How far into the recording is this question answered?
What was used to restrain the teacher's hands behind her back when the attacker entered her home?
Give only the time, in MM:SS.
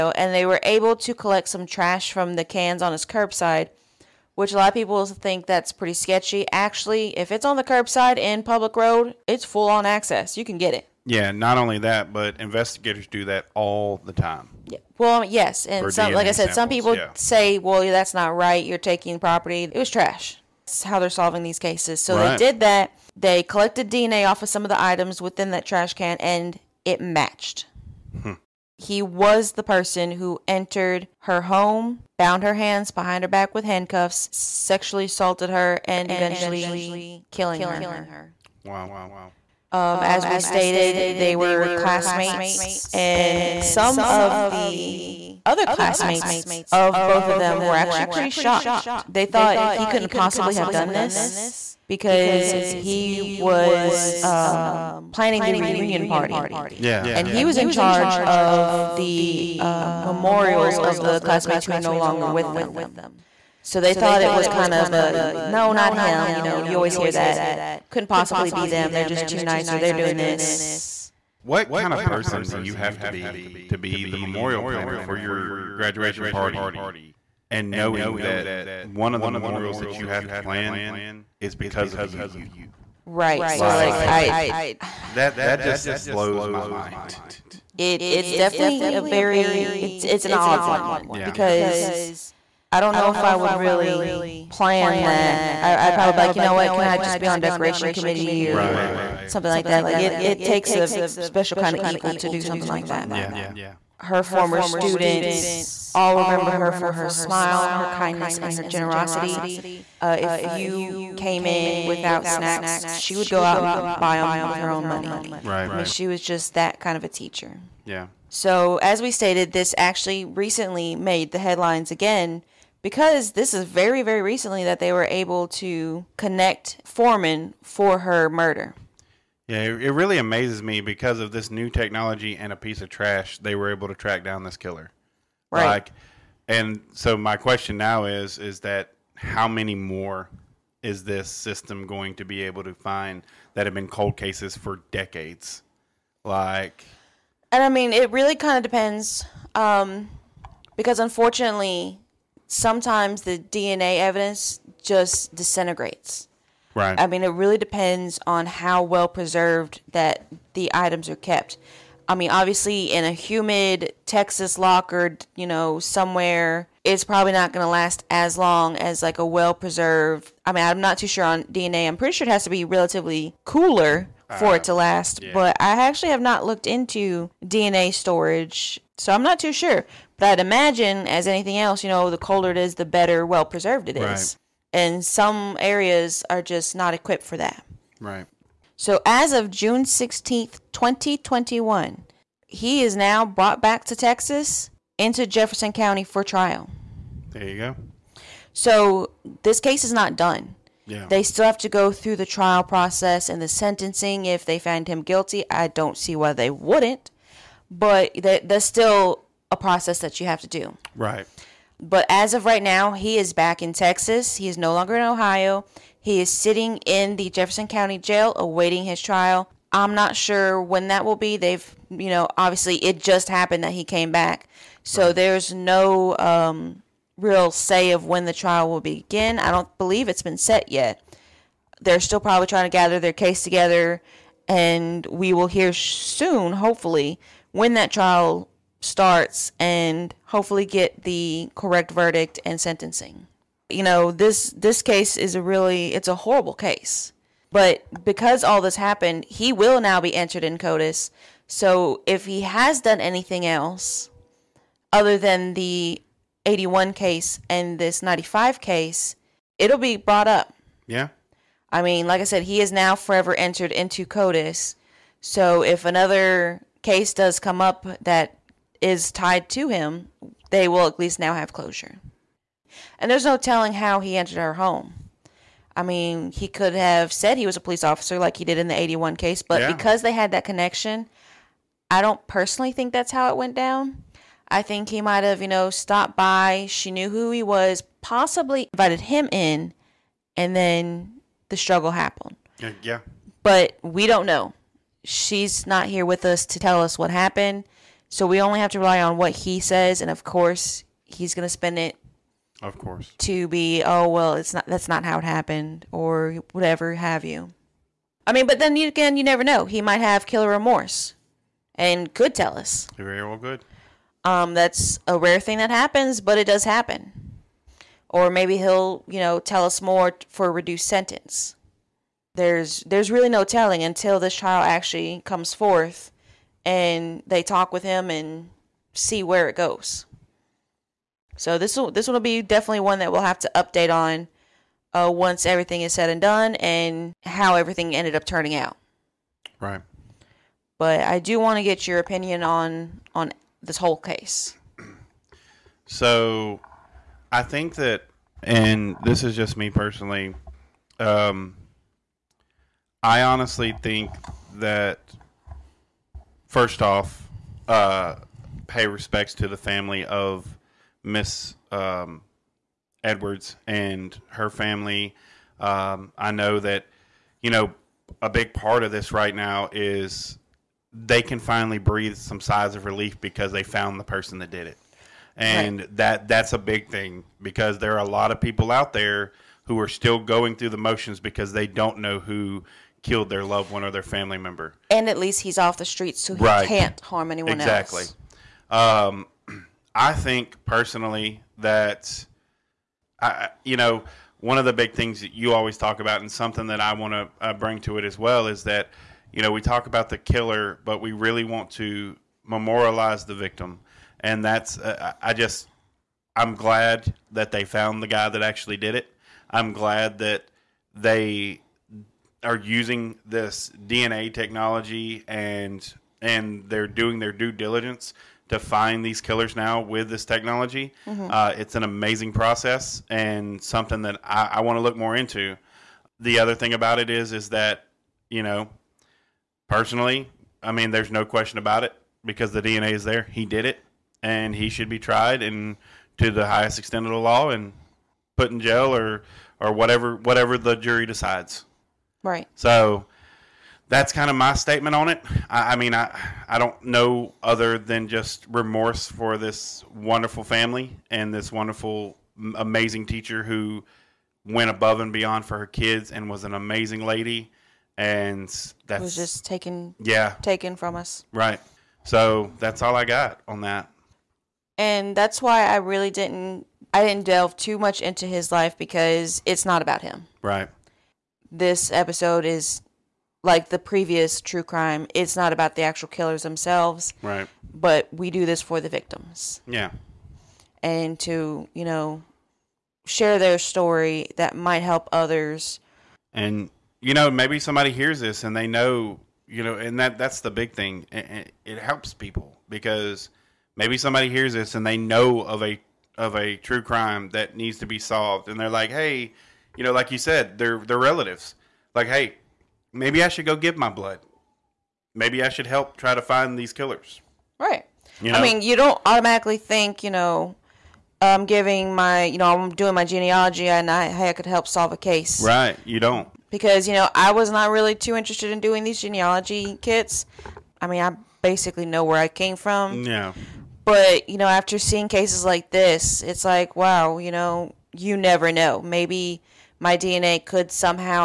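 00:33.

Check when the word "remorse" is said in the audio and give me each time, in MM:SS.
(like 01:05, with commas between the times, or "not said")
05:10, 07:28.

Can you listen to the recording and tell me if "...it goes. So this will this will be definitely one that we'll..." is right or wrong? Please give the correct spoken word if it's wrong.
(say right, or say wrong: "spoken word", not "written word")
right.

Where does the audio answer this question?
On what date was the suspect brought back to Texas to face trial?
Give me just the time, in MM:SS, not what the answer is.
03:09.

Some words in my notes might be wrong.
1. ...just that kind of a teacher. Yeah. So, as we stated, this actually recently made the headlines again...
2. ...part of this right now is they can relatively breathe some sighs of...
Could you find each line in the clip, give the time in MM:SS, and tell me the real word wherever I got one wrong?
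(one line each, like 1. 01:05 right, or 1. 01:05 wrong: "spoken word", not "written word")
1. 01:56 right
2. 06:08 wrong: "finally", not "relatively".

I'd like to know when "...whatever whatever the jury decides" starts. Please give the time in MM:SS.
07:19.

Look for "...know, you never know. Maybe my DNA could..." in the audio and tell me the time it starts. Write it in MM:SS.
08:47.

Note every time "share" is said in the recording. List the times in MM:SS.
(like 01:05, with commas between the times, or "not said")
08:03.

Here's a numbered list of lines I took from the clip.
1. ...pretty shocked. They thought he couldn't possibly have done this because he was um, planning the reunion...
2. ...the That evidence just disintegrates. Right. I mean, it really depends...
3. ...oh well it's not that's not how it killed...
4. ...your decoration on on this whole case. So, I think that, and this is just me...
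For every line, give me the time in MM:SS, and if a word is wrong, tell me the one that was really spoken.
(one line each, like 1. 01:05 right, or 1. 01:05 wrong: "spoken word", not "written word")
1. 00:48 right
2. 02:33 wrong: "DNA", not "That"
3. 05:03 wrong: "happened", not "killed"
4. 05:41 wrong: "opinion", not "decoration".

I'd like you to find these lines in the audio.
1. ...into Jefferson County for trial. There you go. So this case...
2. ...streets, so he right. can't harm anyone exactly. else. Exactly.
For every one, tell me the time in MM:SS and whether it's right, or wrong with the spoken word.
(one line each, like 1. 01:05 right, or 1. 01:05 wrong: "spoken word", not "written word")
1. 03:14 right
2. 06:25 right.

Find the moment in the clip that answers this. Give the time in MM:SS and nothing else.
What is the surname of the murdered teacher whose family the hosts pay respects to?
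06:03.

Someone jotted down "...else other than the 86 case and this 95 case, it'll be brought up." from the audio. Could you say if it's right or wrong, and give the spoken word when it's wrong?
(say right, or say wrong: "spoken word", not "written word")
wrong: "81", not "86".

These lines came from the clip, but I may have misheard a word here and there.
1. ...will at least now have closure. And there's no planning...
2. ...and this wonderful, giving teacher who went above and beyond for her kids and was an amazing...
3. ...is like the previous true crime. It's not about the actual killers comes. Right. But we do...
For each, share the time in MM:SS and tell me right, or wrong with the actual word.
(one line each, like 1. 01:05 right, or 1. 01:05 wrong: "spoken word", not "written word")
1. 04:30 wrong: "telling", not "planning"
2. 07:31 wrong: "amazing", not "giving"
3. 07:52 wrong: "themselves", not "comes".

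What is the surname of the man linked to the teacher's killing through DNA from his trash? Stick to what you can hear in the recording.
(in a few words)
Foreman.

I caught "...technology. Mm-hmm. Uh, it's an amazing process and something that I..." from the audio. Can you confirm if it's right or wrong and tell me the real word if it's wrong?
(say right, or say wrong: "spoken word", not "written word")
right.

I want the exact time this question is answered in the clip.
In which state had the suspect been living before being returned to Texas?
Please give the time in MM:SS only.
03:35.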